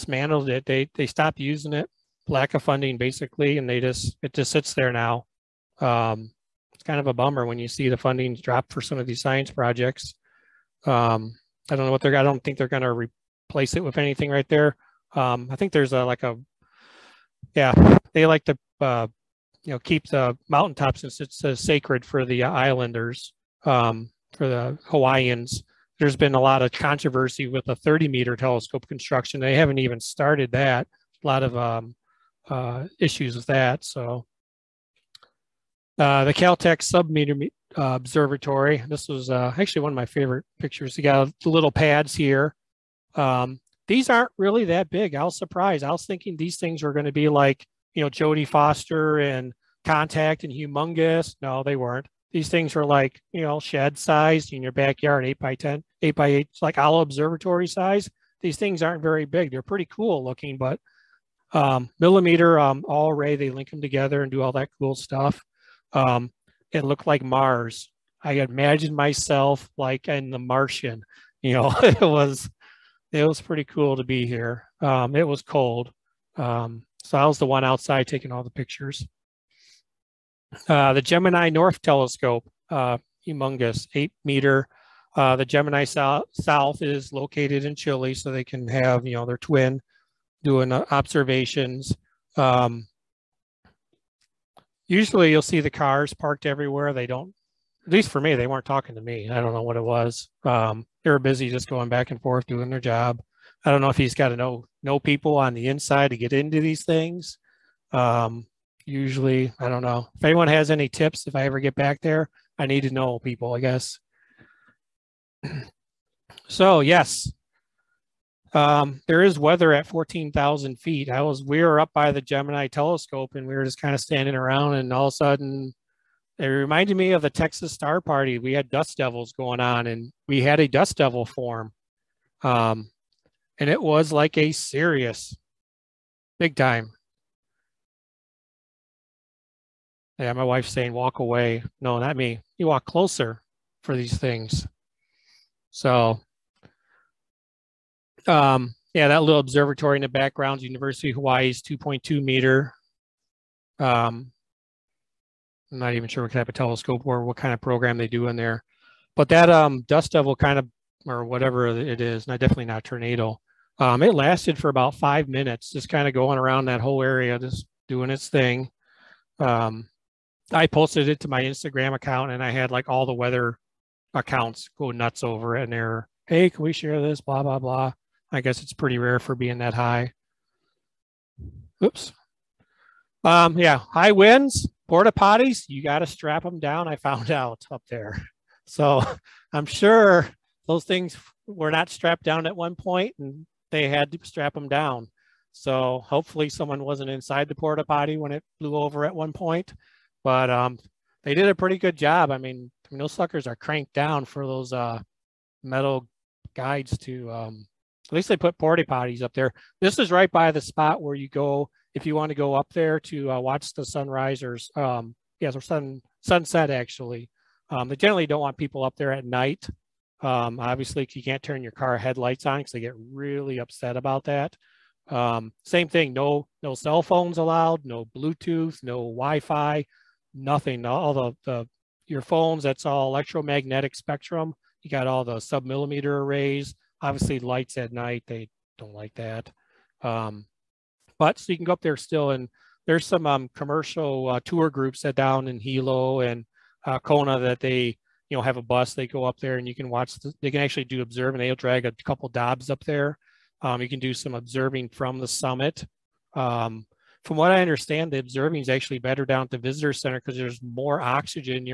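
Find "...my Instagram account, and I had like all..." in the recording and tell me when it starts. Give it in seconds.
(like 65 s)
171 s.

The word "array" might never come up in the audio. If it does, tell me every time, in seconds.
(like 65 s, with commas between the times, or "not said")
63 s, 236 s.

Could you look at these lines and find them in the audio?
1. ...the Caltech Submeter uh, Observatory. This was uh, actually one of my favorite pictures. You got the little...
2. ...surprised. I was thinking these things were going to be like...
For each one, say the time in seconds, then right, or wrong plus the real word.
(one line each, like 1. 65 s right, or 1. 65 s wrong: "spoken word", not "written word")
1. 36 s right
2. 45 s right.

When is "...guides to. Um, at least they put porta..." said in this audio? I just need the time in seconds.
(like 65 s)
206 s.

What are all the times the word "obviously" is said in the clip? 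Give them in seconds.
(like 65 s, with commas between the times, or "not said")
220 s, 237 s.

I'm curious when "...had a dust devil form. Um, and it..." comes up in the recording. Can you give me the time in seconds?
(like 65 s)
130 s.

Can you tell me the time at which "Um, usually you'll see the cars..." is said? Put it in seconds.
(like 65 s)
92 s.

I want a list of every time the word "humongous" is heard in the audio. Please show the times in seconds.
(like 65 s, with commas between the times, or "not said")
50 s, 83 s.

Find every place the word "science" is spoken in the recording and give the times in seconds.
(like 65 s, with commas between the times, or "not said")
9 s.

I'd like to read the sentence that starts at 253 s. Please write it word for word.
Um, you can do some observing from the summit.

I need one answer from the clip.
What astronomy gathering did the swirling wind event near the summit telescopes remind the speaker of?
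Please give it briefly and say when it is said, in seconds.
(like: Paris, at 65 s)
Texas Star Party, at 127 s.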